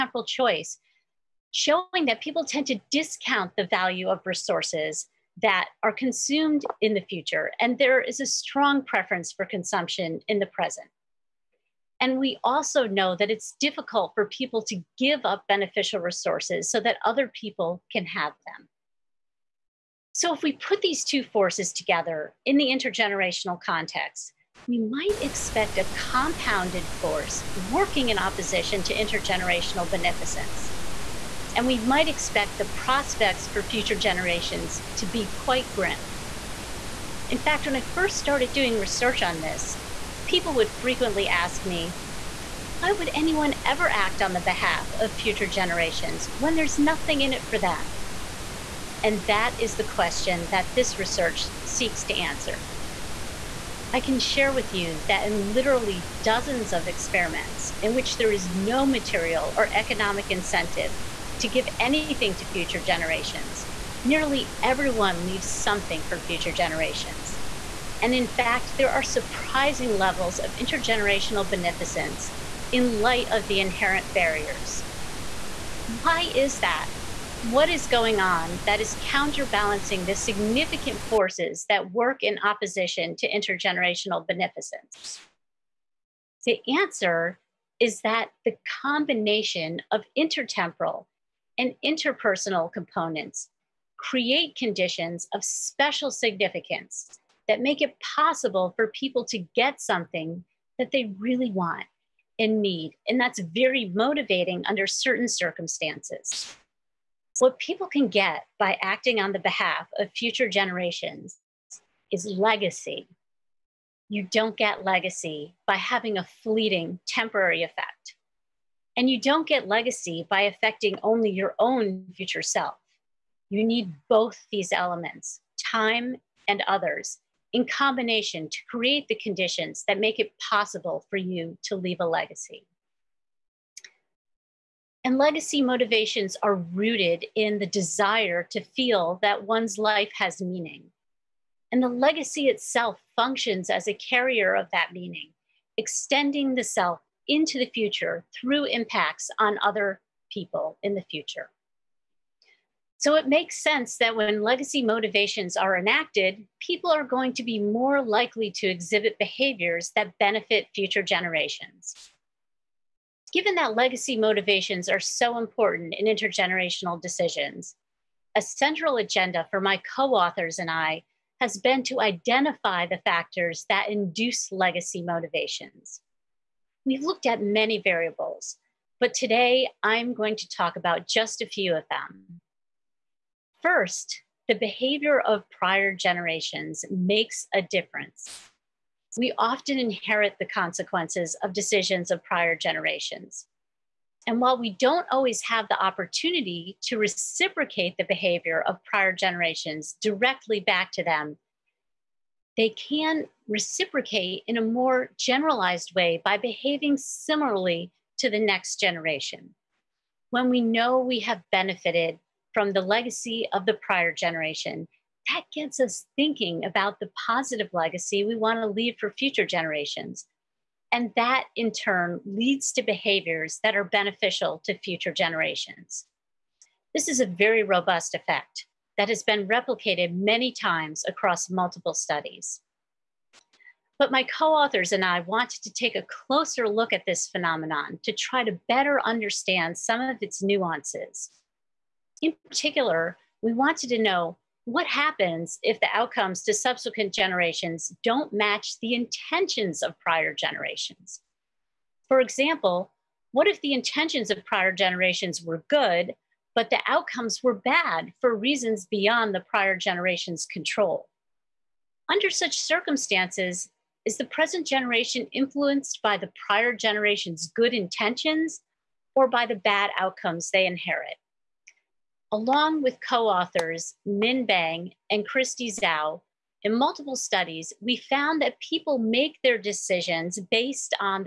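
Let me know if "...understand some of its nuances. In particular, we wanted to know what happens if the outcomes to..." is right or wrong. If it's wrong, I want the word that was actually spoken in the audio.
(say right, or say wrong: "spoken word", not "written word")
right.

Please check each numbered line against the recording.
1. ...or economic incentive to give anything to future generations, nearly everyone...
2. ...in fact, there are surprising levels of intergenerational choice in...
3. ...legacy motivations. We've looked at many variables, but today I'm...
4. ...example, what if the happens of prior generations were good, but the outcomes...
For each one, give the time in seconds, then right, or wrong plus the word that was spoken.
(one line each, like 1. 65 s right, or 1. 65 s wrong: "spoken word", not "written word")
1. 59 s right
2. 68 s wrong: "beneficence", not "choice"
3. 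174 s right
4. 252 s wrong: "intentions", not "happens".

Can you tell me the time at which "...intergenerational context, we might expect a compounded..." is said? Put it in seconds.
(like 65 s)
22 s.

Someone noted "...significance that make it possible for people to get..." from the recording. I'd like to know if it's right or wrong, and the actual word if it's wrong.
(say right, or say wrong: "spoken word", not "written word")
right.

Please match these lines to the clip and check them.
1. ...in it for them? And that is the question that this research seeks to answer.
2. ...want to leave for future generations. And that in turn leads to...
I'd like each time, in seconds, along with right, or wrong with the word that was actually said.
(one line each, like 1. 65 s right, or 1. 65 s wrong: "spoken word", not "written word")
1. 47 s right
2. 218 s right.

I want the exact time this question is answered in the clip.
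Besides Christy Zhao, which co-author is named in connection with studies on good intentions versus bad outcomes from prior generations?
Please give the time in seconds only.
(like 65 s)
274 s.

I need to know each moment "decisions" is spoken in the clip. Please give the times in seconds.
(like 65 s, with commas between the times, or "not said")
167 s, 191 s, 279 s.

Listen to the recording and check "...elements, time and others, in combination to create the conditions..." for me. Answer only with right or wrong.
right.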